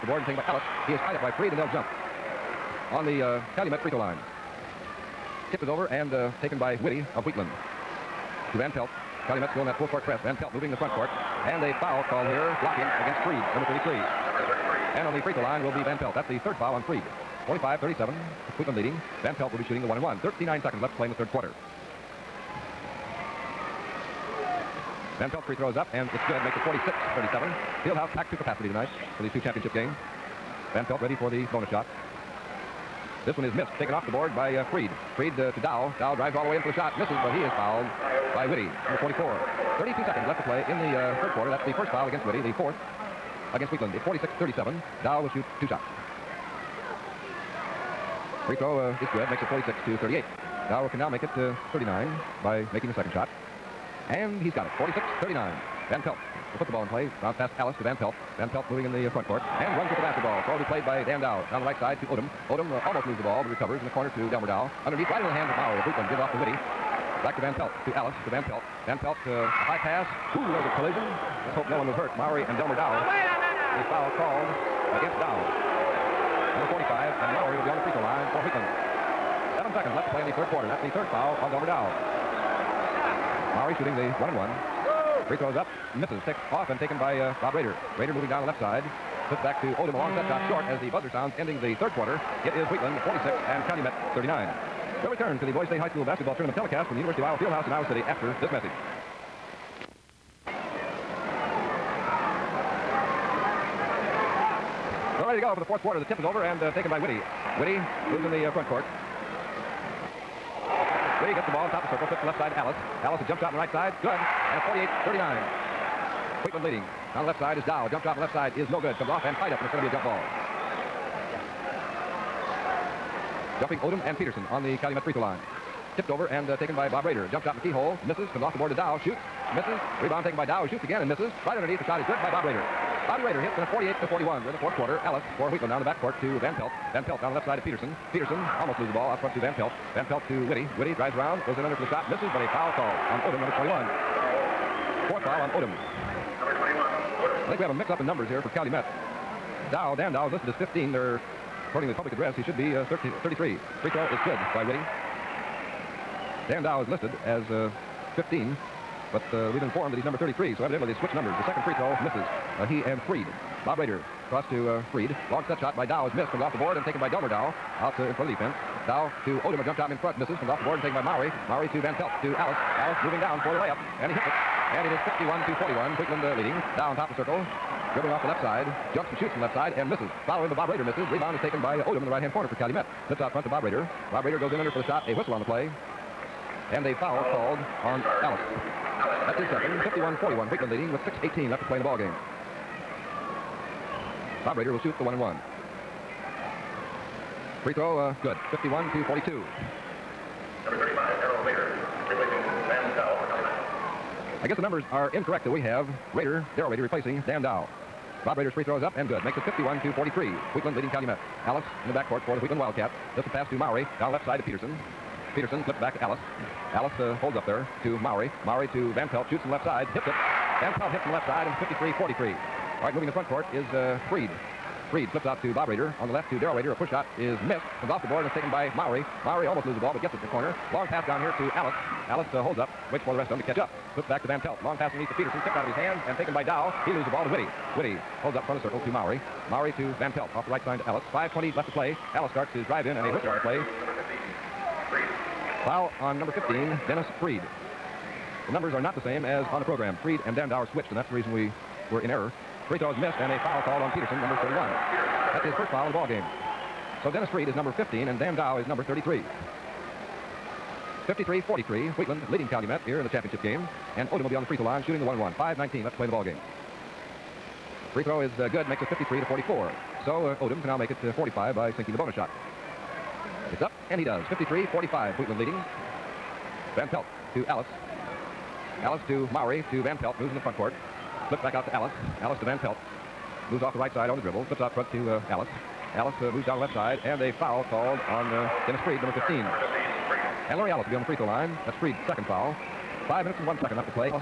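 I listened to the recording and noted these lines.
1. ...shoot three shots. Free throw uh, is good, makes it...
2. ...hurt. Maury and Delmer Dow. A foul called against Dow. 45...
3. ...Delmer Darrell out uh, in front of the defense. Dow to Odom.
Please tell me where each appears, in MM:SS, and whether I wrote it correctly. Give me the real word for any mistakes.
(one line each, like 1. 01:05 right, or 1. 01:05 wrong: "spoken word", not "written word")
1. 00:45 wrong: "two", not "three"
2. 01:11 right
3. 02:47 wrong: "Dow", not "Darrell".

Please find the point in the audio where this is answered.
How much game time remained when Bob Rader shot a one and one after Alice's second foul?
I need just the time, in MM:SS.
03:11.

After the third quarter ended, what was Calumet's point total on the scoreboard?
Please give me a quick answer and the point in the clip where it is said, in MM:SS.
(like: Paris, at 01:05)
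39, at 01:33.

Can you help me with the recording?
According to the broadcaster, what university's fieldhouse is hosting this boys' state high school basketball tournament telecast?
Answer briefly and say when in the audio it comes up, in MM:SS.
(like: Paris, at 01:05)
University of Iowa, at 01:36.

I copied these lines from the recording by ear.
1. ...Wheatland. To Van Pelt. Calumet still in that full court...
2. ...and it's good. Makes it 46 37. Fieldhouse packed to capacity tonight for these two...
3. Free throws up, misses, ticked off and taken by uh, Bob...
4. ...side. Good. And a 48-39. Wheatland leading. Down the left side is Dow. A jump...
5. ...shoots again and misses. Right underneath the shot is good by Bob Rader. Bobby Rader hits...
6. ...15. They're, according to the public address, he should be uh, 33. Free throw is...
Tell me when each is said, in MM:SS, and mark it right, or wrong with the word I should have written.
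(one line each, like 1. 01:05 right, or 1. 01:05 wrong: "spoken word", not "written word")
1. 00:07 right
2. 00:25 right
3. 01:25 right
4. 01:53 right
5. 02:10 right
6. 02:30 right.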